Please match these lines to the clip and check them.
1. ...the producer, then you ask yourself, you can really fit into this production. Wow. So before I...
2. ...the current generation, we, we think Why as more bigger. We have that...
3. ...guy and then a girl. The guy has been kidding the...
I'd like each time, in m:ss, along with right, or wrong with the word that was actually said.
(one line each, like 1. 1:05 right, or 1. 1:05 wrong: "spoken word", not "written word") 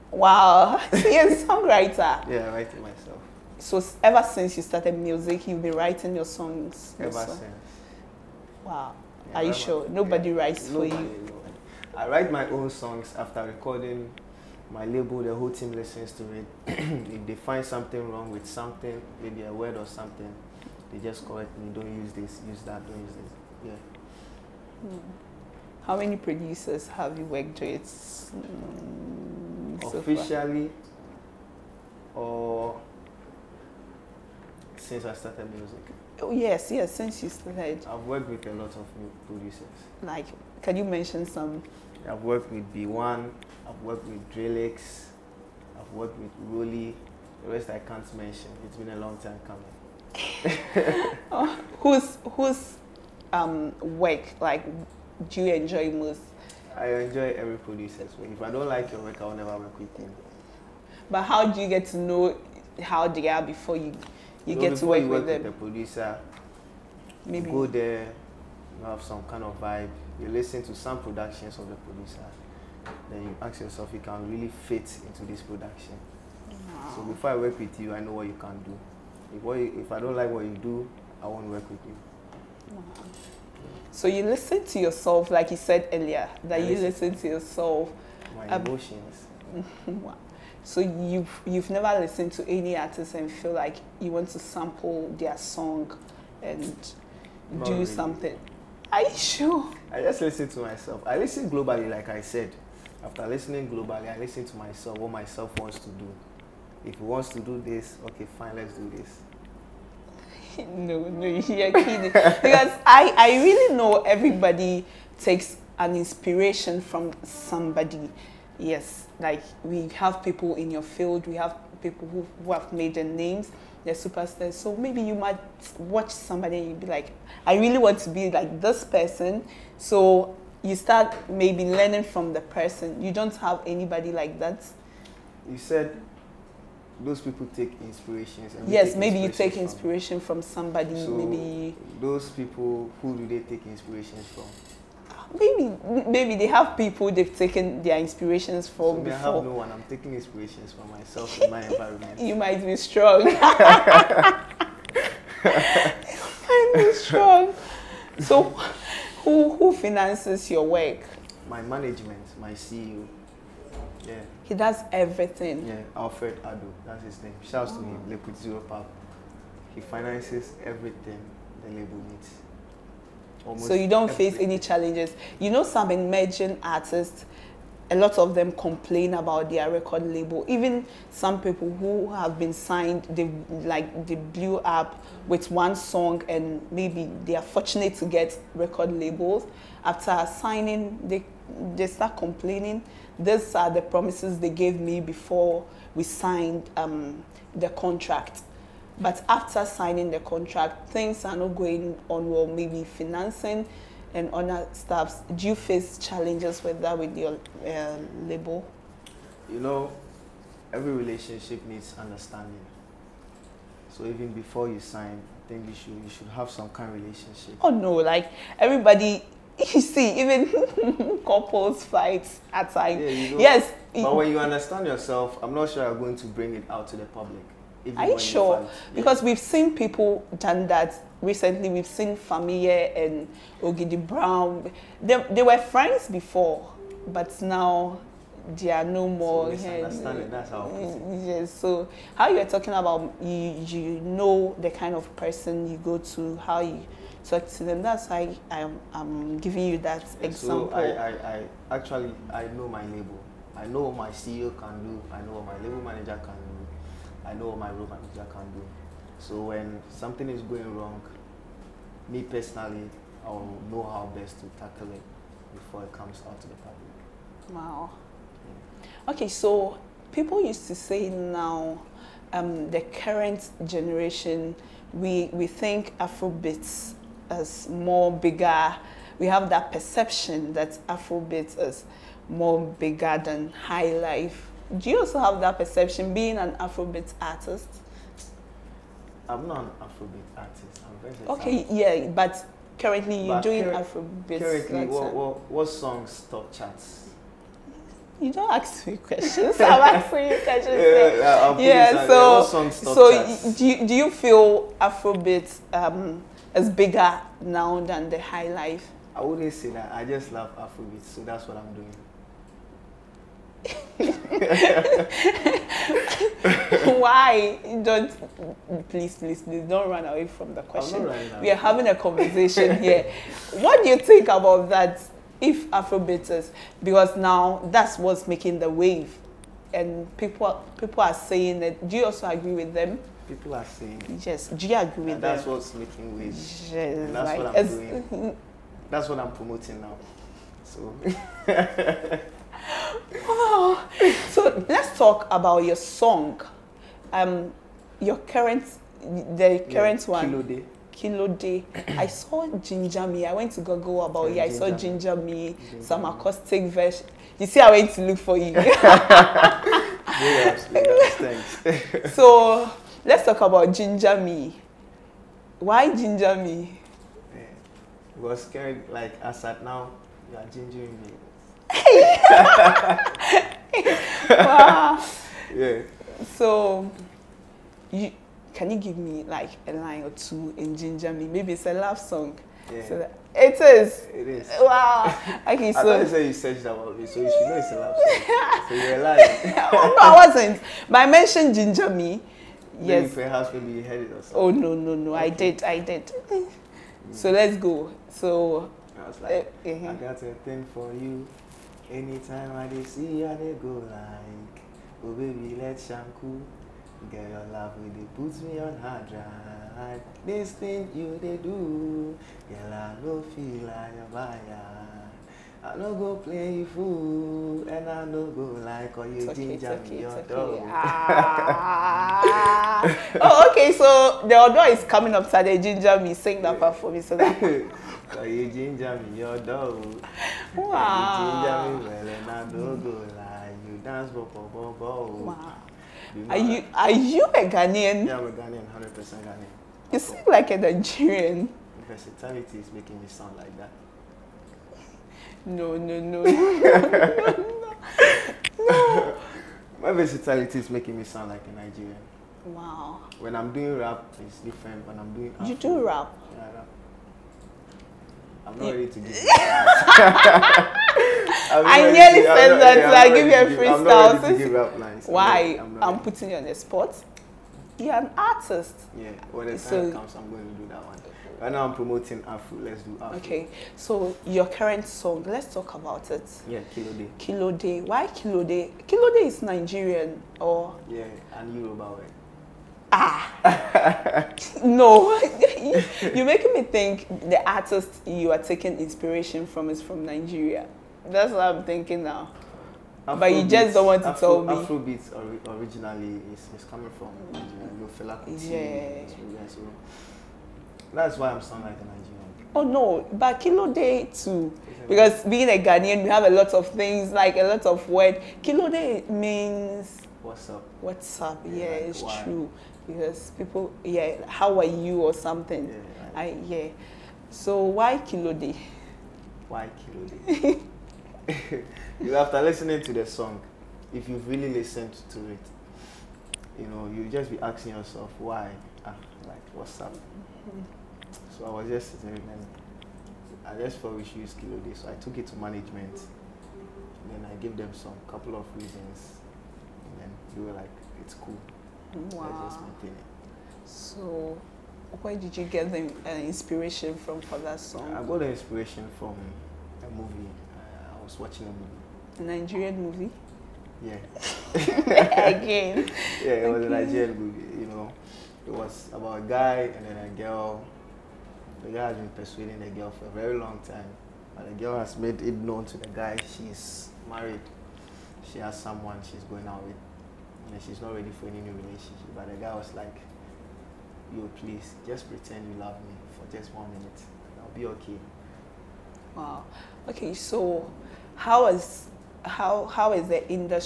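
1. 1:11 right
2. 4:32 wrong: "Afrobeats", not "Why"
3. 9:19 wrong: "persuading", not "kidding".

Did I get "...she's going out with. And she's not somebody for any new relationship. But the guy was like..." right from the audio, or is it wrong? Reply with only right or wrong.
wrong.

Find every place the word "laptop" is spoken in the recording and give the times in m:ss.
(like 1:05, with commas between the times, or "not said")
not said.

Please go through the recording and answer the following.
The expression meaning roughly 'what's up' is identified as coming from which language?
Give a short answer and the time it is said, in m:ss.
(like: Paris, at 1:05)
Yoruba, at 8:01.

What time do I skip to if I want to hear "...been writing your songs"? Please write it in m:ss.
0:05.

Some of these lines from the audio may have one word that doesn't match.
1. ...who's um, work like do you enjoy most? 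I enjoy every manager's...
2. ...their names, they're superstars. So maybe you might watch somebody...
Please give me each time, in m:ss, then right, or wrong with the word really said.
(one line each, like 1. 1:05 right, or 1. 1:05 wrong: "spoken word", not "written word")
1. 0:52 wrong: "producer", not "manager"
2. 2:02 right.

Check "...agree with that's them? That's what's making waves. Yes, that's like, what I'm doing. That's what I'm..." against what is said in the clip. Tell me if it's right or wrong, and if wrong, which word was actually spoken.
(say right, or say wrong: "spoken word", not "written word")
right.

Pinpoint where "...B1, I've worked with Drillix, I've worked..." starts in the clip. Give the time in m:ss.
0:42.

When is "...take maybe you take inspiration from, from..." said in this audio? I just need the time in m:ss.
2:18.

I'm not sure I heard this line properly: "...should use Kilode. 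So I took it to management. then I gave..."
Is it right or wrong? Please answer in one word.
right.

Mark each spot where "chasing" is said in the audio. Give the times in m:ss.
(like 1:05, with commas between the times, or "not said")
not said.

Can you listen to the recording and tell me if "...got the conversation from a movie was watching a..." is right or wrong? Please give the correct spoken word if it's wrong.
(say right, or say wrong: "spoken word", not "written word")
wrong: "inspiration", not "conversation".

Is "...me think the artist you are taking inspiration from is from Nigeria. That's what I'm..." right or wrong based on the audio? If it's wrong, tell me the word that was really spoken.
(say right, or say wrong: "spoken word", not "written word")
right.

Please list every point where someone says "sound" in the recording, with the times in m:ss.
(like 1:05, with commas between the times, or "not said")
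7:23, 7:31, 8:21.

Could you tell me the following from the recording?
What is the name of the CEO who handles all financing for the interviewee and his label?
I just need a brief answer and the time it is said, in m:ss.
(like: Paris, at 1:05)
Alfred Ado, at 2:45.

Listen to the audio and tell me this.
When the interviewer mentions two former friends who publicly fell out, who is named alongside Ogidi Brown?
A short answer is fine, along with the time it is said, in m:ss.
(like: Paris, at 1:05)
Fameye, at 3:52.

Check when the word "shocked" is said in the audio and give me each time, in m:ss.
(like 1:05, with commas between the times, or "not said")
not said.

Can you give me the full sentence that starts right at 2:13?
You don't have anybody like that.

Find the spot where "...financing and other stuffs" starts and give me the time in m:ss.
3:22.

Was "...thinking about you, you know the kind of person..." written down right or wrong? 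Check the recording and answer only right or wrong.
wrong.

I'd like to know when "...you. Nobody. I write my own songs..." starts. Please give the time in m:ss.
0:10.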